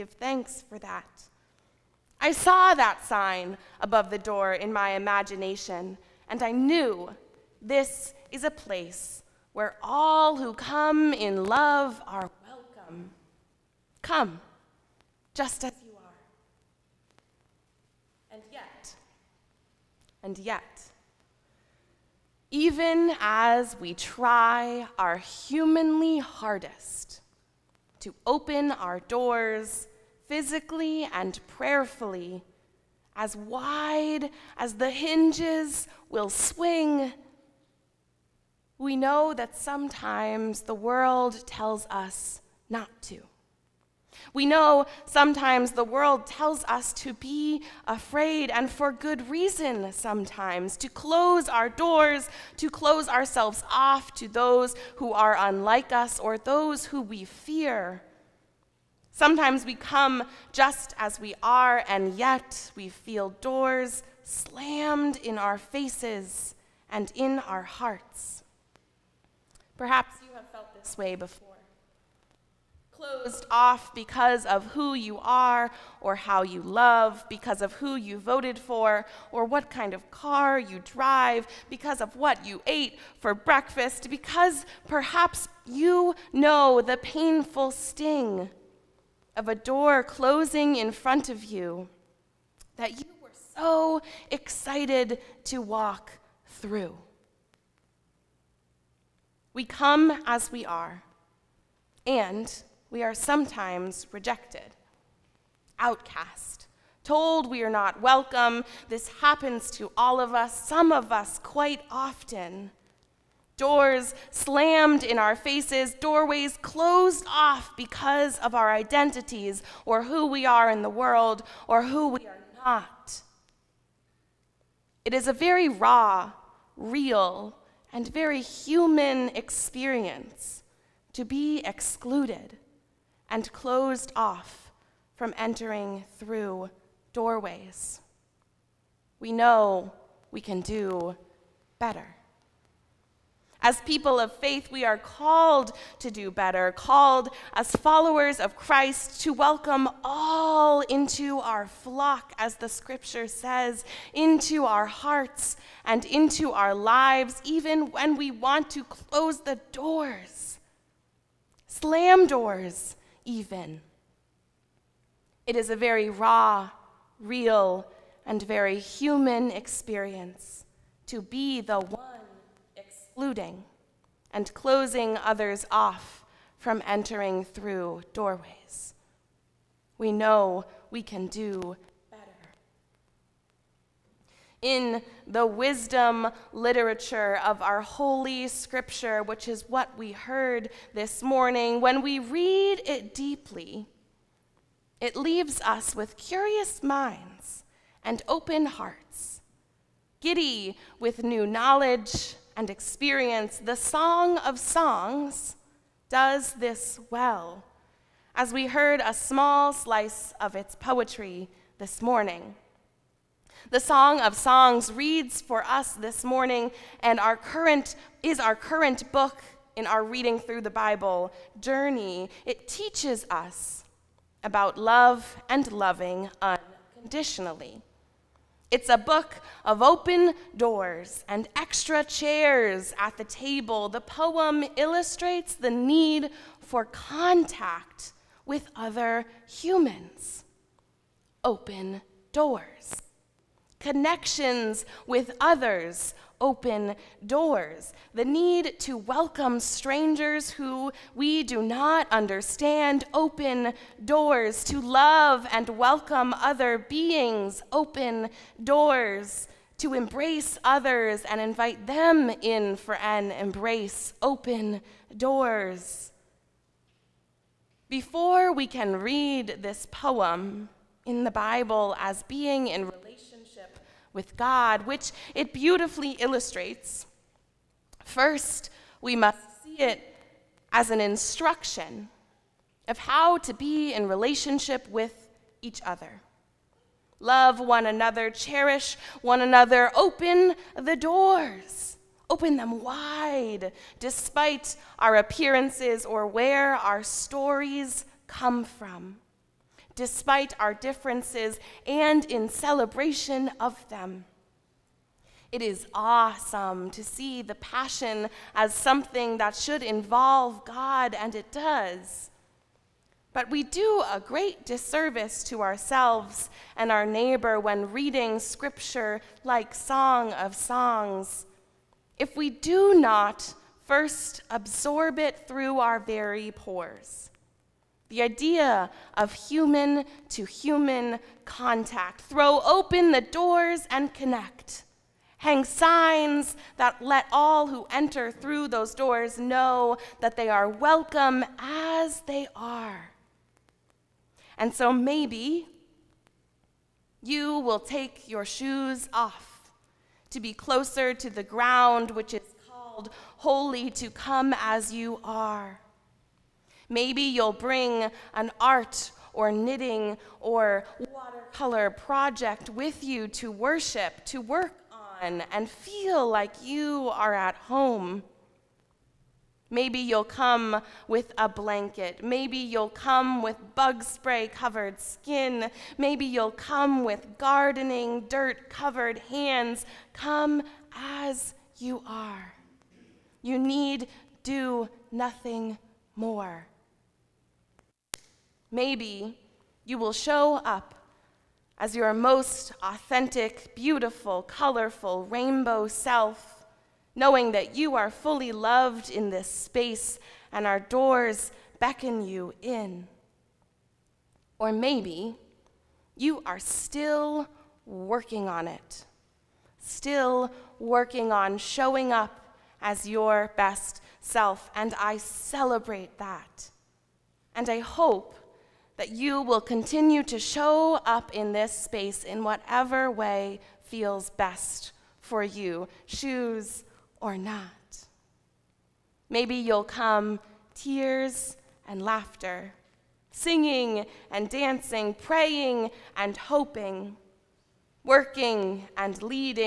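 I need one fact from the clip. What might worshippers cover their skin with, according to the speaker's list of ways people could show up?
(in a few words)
Bug spray.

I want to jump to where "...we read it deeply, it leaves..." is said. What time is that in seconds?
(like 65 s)
192 s.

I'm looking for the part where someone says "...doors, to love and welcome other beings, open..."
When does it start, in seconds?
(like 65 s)
254 s.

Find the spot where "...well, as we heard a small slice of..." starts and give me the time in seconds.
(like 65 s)
207 s.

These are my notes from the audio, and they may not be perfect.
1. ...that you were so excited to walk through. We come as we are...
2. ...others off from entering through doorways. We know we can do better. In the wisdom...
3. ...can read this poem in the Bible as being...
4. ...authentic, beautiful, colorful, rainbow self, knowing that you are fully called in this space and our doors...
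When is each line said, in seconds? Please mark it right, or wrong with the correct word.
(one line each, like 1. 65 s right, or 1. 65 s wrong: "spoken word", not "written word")
1. 92 s right
2. 175 s right
3. 268 s right
4. 392 s wrong: "loved", not "called".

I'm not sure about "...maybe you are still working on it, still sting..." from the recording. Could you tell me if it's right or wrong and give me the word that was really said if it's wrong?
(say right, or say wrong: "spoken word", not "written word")
wrong: "working", not "sting".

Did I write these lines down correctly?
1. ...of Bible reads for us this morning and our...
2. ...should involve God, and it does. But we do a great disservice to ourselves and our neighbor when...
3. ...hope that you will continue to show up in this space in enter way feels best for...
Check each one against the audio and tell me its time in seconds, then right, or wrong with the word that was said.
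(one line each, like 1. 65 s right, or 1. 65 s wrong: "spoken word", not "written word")
1. 214 s wrong: "Songs", not "Bible"
2. 309 s right
3. 417 s wrong: "whatever", not "enter".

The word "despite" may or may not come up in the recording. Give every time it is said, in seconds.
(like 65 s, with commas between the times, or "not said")
293 s, 299 s.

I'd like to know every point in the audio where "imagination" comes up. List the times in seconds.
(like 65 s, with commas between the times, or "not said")
4 s.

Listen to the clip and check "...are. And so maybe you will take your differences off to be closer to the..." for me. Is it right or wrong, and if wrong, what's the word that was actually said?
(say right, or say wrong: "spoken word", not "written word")
wrong: "shoes", not "differences".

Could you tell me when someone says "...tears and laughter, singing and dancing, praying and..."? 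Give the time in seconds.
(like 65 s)
430 s.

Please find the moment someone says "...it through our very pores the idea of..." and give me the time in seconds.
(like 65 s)
325 s.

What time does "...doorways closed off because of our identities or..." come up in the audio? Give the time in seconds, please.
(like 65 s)
115 s.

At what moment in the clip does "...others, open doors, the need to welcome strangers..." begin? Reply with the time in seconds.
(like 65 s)
245 s.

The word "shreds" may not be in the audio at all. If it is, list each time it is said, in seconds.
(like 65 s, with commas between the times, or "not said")
not said.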